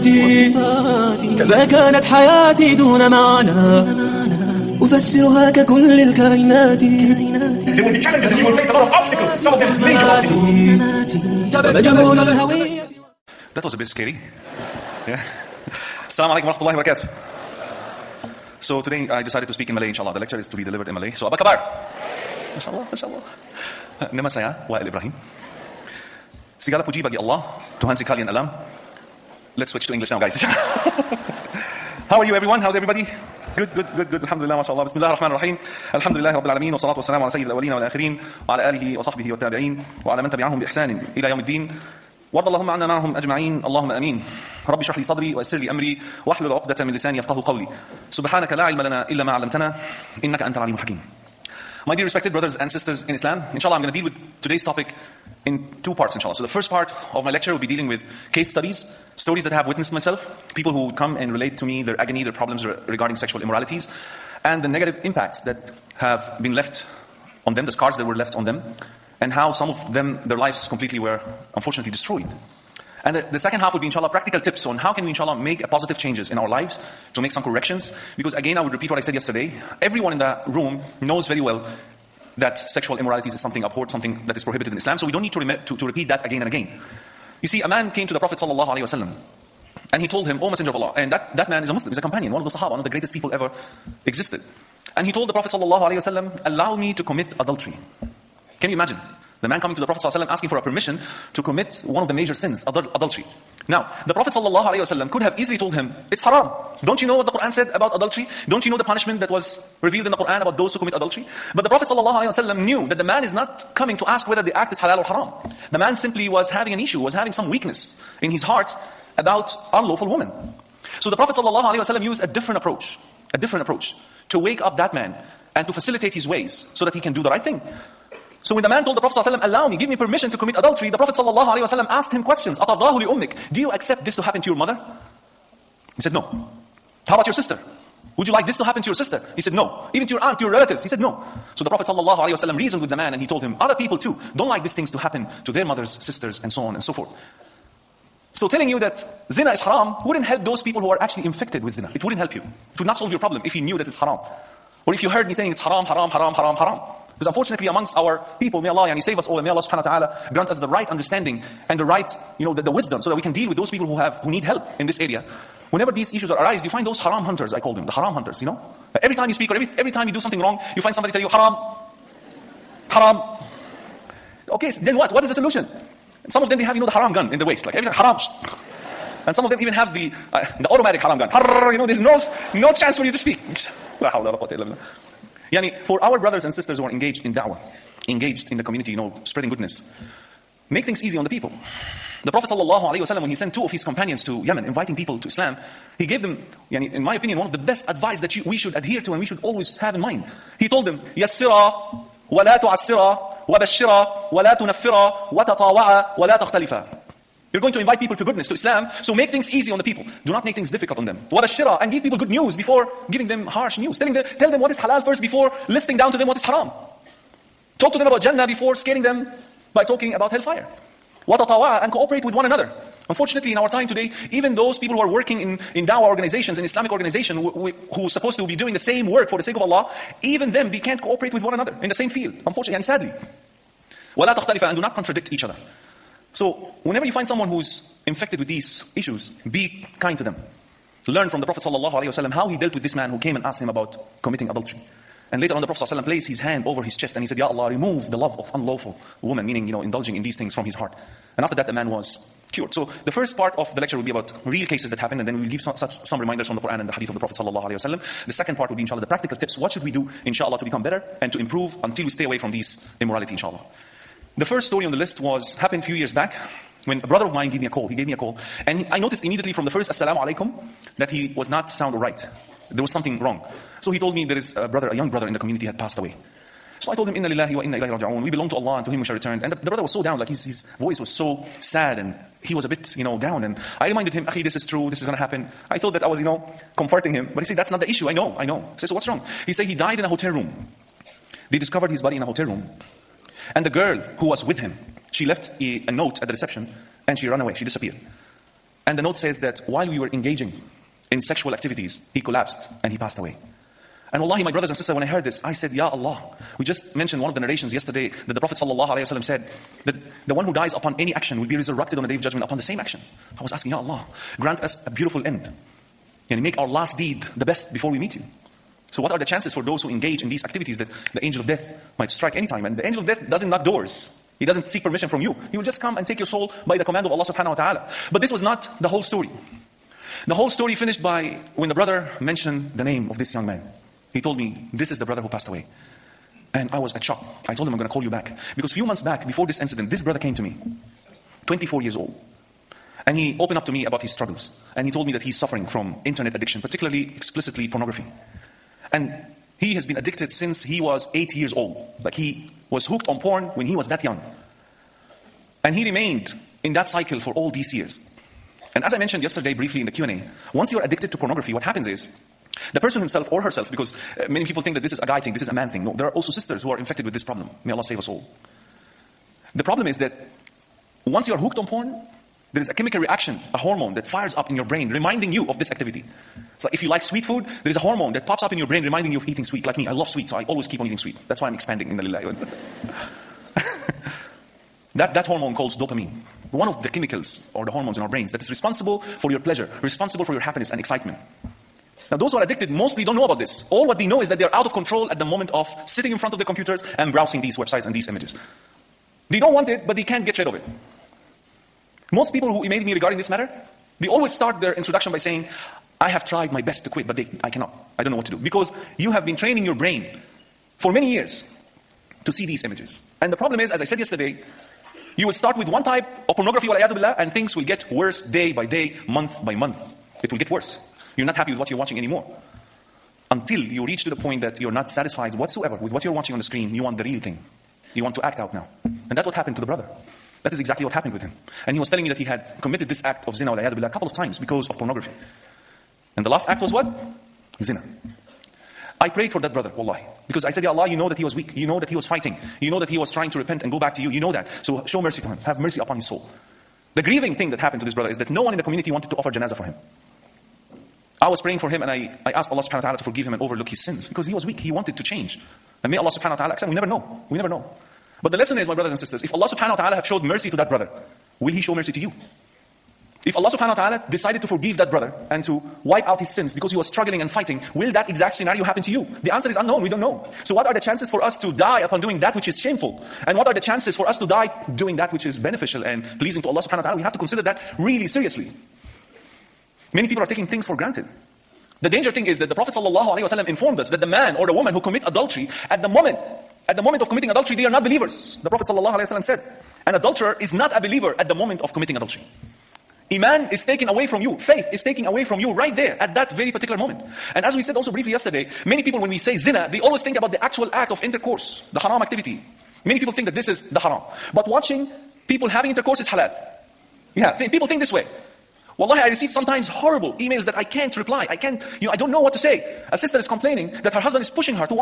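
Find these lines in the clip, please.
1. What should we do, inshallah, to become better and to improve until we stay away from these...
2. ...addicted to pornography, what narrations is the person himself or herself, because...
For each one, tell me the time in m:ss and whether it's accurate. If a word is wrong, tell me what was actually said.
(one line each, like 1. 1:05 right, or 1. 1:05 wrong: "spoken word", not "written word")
1. 4:19 right
2. 6:00 wrong: "happens", not "narrations".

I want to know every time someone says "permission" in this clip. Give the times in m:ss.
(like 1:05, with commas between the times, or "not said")
1:40, 2:09, 5:24.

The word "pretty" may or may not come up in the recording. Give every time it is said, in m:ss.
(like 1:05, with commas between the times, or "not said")
not said.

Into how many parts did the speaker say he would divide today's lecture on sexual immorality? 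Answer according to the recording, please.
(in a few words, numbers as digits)
2.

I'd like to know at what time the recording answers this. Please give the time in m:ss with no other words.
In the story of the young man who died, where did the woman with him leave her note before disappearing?
4:56.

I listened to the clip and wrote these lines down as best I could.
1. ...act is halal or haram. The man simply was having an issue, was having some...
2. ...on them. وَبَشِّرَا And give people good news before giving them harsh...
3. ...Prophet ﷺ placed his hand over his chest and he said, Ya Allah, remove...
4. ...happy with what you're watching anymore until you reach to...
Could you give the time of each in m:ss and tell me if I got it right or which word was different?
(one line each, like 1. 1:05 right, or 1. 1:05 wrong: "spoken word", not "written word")
1. 1:54 right
2. 3:30 right
3. 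4:05 right
4. 7:01 right.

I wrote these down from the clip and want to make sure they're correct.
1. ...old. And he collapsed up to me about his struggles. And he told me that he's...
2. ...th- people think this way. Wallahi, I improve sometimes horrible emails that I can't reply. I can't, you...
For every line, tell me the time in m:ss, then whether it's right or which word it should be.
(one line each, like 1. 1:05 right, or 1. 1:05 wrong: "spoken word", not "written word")
1. 5:41 wrong: "opened", not "collapsed"
2. 8:27 wrong: "receive", not "improve".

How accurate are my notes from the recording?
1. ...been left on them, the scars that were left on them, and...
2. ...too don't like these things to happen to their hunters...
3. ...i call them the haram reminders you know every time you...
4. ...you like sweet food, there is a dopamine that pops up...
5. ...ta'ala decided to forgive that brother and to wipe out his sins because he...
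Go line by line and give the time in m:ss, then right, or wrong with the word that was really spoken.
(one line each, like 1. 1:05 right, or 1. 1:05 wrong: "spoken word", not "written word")
1. 1:06 right
2. 2:23 wrong: "mothers", not "hunters"
3. 2:47 wrong: "hunters", not "reminders"
4. 6:16 wrong: "hormone", not "dopamine"
5. 7:43 right.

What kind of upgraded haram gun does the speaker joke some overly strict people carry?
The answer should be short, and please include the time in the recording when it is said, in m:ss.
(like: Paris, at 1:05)
Automatic, at 3:00.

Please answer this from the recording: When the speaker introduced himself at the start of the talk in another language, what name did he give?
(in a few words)
Wael Ibrahim.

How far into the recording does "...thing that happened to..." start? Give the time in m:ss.
7:27.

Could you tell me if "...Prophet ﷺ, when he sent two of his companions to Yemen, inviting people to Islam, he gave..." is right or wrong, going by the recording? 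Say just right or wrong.
right.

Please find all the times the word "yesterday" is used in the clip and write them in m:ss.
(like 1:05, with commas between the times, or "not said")
1:19, 5:07, 5:59, 6:53, 8:18.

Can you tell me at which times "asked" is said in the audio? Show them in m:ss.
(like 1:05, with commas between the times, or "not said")
2:11, 4:03, 7:32.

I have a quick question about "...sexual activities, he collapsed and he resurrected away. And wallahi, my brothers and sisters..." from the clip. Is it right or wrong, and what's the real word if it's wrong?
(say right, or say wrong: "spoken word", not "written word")
wrong: "passed", not "resurrected".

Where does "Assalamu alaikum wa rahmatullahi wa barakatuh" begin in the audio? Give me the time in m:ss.
0:16.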